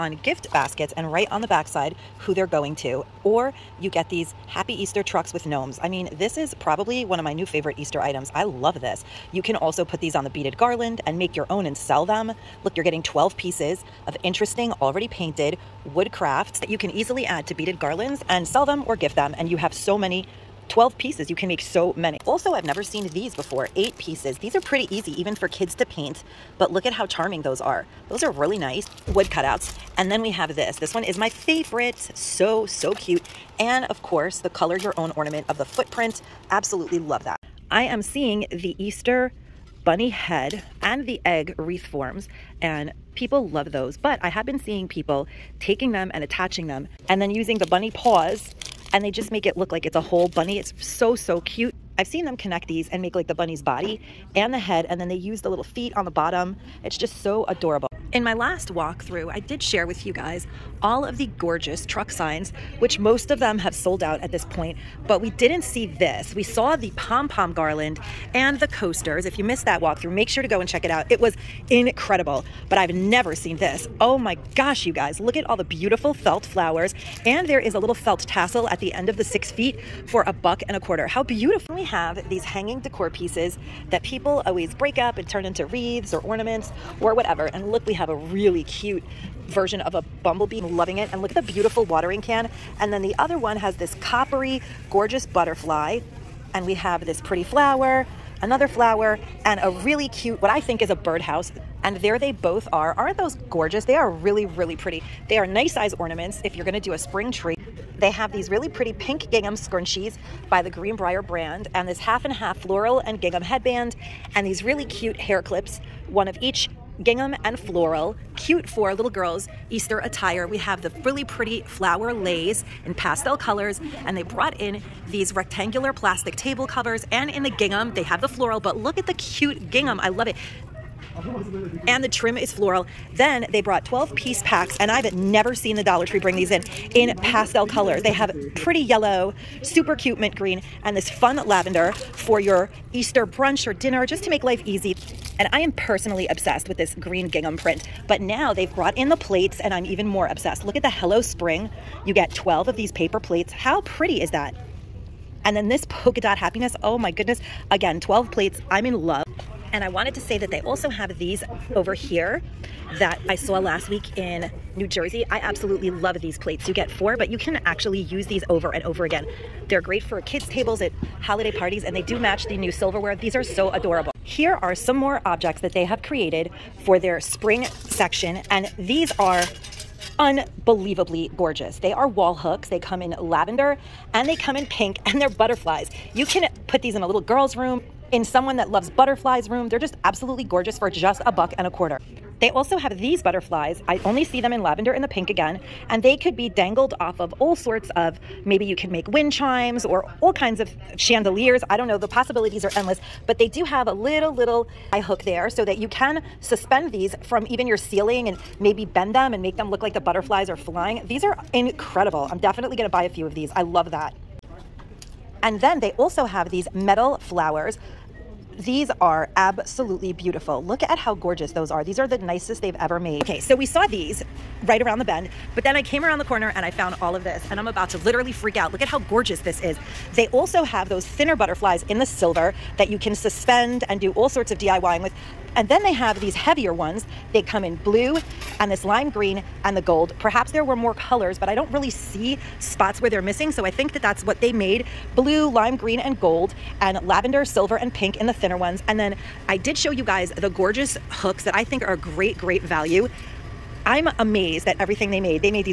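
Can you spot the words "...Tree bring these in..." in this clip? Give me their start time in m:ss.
2:16.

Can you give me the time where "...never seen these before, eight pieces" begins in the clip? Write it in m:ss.
0:22.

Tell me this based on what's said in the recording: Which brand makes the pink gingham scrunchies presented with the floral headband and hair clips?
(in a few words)
Greenbrier.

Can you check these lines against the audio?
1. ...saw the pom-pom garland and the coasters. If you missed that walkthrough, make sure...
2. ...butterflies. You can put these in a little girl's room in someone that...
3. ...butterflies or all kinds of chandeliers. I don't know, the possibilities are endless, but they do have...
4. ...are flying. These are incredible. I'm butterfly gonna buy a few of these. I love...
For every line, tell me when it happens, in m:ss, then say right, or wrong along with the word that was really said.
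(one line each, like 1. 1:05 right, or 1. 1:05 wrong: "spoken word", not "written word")
1. 1:06 right
2. 3:05 right
3. 3:19 wrong: "chimes", not "butterflies"
4. 3:30 wrong: "definitely", not "butterfly".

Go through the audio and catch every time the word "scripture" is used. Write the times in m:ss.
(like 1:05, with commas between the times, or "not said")
not said.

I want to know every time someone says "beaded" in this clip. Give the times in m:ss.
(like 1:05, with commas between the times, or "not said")
0:10, 0:17.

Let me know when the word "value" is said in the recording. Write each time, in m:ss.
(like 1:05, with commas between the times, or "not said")
4:12.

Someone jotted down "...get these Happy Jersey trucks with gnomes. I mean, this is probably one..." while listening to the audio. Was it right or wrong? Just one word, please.
wrong.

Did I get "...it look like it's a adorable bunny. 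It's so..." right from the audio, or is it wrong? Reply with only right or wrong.
wrong.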